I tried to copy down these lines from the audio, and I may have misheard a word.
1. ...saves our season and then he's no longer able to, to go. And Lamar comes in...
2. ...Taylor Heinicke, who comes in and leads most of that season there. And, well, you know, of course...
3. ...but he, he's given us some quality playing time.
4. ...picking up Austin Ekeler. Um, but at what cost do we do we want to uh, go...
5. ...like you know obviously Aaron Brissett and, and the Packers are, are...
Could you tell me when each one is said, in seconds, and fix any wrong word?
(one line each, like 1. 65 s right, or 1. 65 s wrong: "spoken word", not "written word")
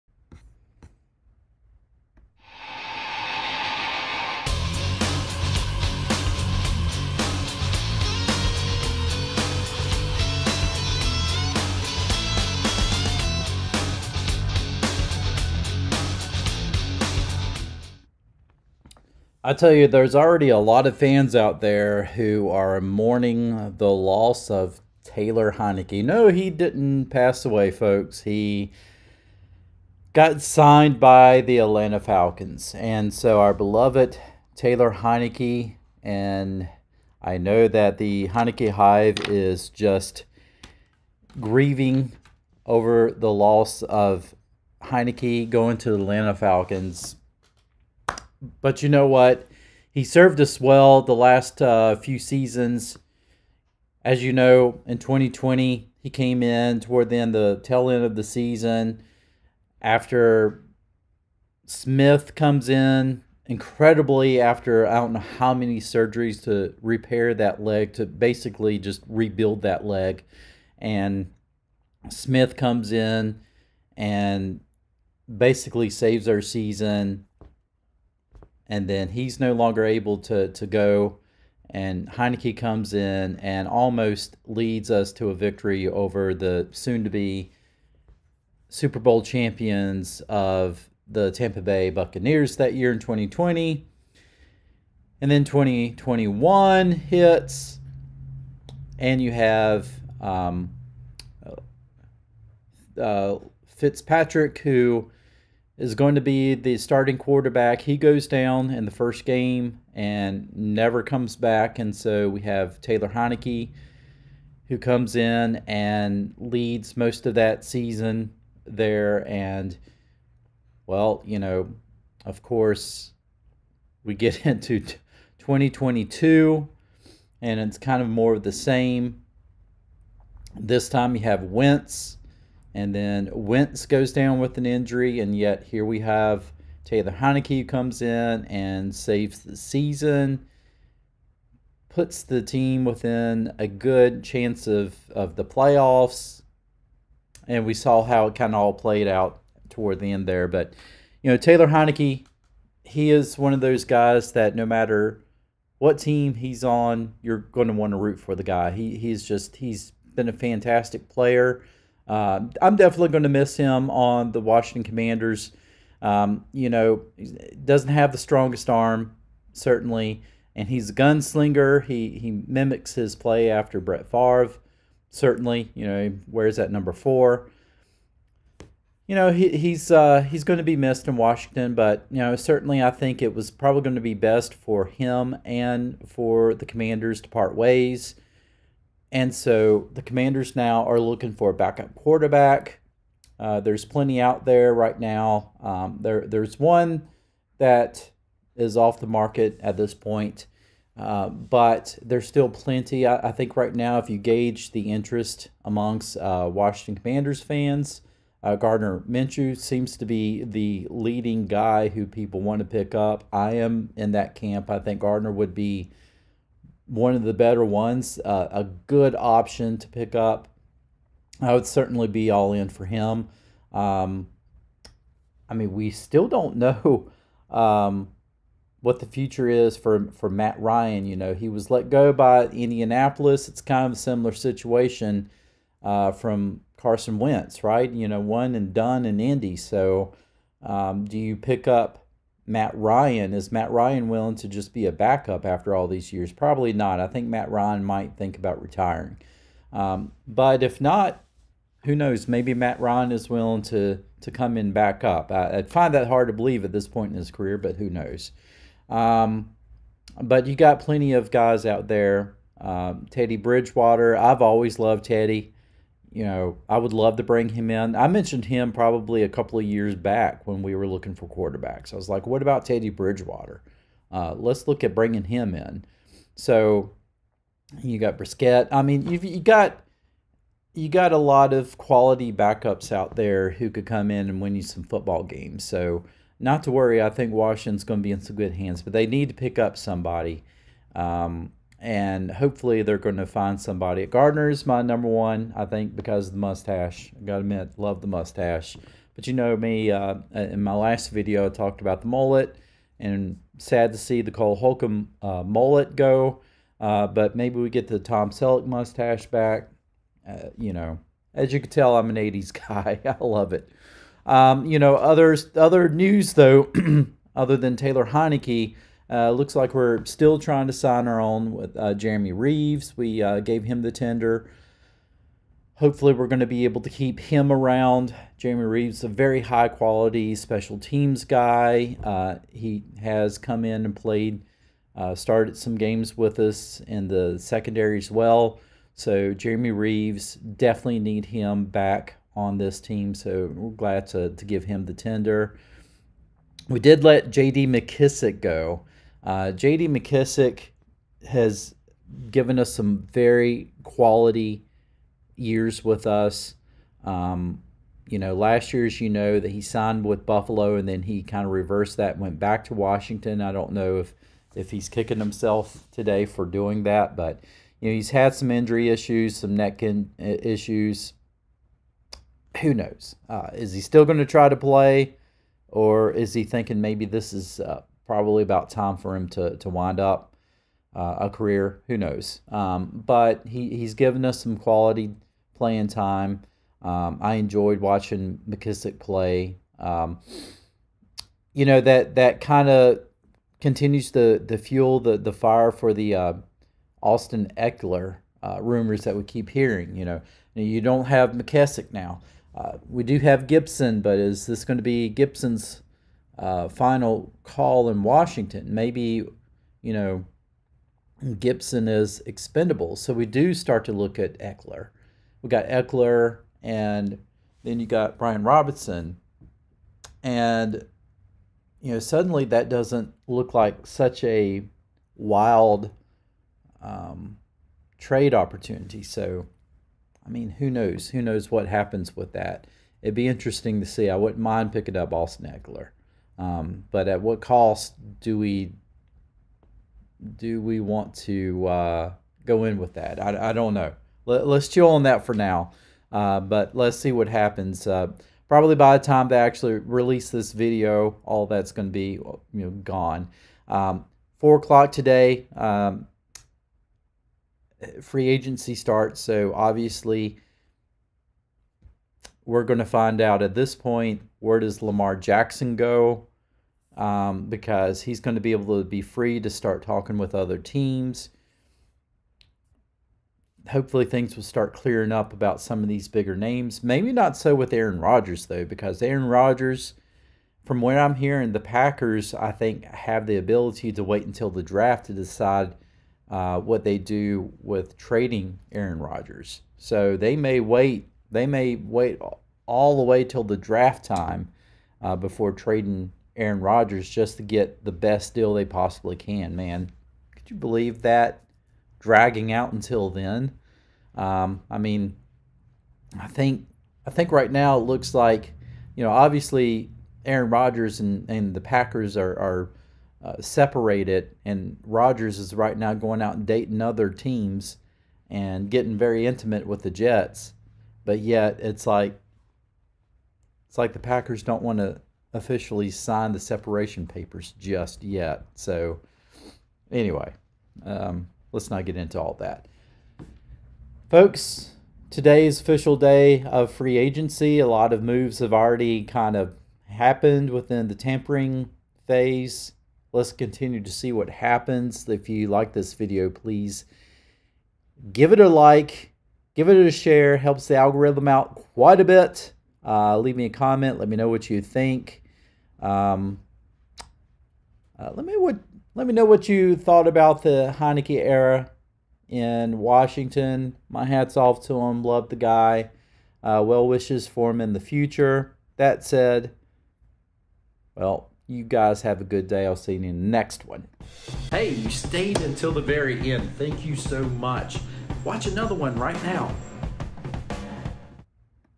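1. 75 s wrong: "Heinicke", not "Lamar"
2. 112 s right
3. 383 s right
4. 434 s right
5. 508 s wrong: "Rodgers", not "Brissett".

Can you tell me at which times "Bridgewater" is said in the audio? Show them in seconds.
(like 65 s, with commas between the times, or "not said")
263 s, 272 s.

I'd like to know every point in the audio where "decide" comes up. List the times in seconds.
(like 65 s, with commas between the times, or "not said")
485 s.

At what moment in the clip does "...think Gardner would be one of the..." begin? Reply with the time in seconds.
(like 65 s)
214 s.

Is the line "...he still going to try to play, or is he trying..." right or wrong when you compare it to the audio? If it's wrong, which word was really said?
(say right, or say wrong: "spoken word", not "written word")
wrong: "thinking", not "trying".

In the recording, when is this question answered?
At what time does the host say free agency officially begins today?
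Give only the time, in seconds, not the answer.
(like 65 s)
454 s.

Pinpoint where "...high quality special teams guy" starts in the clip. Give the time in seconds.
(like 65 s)
329 s.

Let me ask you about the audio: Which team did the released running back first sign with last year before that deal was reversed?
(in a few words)
Buffalo.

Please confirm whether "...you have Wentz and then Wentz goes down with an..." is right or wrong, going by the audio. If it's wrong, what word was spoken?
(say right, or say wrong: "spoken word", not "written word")
right.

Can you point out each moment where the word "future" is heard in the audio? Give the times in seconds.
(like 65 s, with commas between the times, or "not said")
229 s, 567 s.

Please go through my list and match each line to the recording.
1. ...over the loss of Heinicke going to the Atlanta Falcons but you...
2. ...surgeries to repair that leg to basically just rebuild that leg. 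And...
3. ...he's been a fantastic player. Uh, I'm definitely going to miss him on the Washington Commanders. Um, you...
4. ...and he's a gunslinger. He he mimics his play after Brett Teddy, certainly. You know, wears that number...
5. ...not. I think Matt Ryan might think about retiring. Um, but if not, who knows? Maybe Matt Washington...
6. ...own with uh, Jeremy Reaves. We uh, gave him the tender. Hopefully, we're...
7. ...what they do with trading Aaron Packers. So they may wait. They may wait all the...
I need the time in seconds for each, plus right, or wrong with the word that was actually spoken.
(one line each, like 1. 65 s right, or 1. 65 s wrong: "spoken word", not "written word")
1. 42 s right
2. 65 s right
3. 159 s right
4. 170 s wrong: "Favre", not "Teddy"
5. 246 s wrong: "Ryan", not "Washington"
6. 321 s right
7. 486 s wrong: "Rodgers", not "Packers".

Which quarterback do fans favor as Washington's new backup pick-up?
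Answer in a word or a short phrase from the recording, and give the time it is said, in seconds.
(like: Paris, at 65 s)
Gardner Minshew, at 208 s.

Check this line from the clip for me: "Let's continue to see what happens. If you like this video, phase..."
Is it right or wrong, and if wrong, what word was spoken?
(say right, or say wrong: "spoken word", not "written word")
wrong: "please", not "phase".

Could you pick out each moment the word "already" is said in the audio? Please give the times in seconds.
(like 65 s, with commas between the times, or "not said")
20 s, 538 s.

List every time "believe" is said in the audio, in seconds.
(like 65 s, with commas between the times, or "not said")
256 s, 500 s.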